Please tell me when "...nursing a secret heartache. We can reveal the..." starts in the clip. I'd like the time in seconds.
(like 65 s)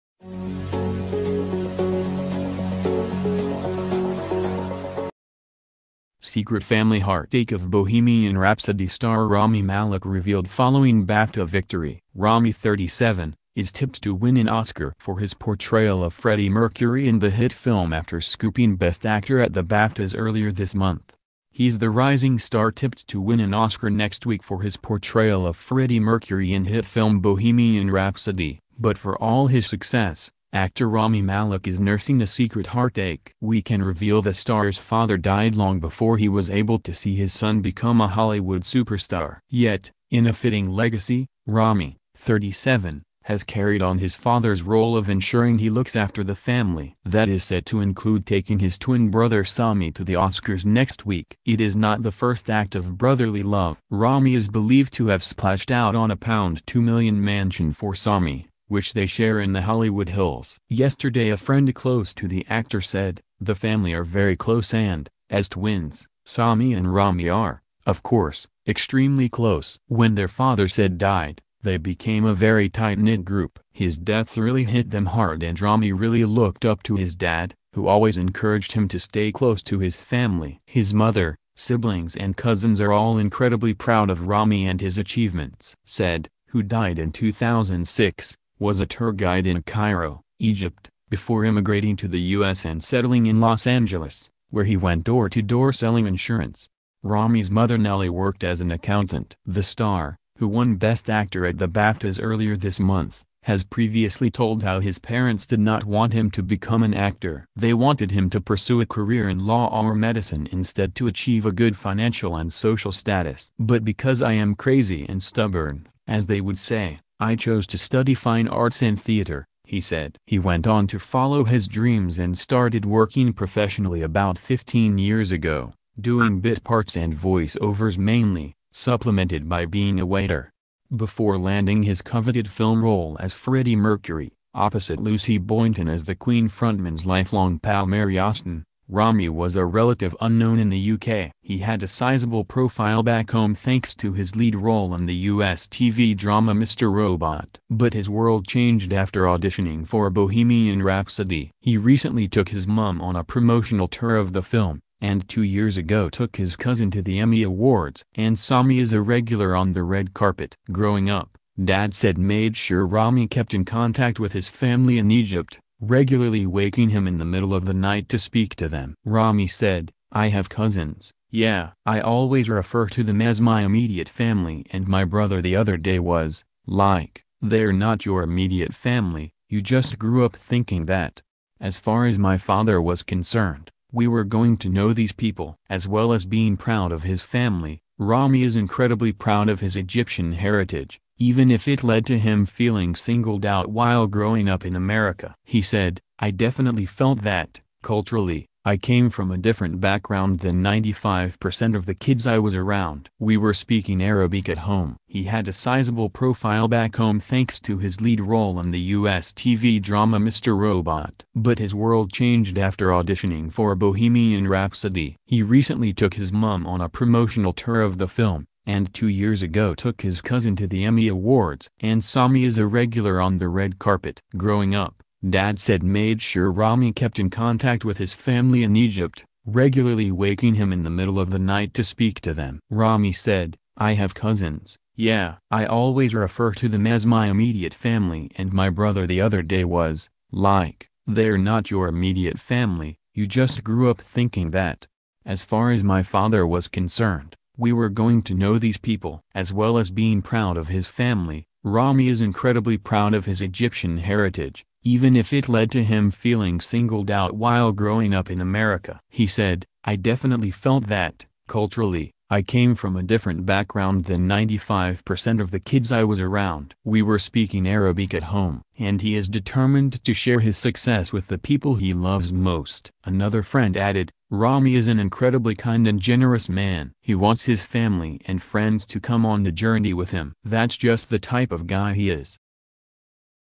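31 s.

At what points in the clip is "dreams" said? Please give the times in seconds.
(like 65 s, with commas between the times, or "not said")
121 s.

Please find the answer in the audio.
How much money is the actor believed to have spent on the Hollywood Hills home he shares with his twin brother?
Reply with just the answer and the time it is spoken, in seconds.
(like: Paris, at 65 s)
£2 million, at 56 s.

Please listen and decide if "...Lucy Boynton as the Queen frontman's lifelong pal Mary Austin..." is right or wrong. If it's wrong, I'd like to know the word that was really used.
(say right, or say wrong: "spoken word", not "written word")
right.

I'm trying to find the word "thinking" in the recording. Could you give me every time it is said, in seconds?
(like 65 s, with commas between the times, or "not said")
180 s, 244 s.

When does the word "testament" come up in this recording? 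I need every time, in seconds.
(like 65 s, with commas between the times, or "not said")
not said.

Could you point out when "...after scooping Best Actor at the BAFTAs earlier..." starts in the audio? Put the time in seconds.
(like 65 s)
17 s.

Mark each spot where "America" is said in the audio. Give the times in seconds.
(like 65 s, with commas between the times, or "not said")
194 s, 258 s.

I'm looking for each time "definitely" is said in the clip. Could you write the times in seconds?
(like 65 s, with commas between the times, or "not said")
196 s, 259 s.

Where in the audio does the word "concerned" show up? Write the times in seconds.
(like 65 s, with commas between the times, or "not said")
183 s, 246 s.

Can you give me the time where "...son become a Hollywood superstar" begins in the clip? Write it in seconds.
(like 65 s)
37 s.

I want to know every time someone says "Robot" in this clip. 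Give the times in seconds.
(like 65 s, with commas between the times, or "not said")
146 s, 210 s.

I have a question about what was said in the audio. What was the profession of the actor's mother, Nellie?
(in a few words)
Accountant.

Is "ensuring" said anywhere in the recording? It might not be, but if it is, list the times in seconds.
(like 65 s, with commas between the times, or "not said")
45 s.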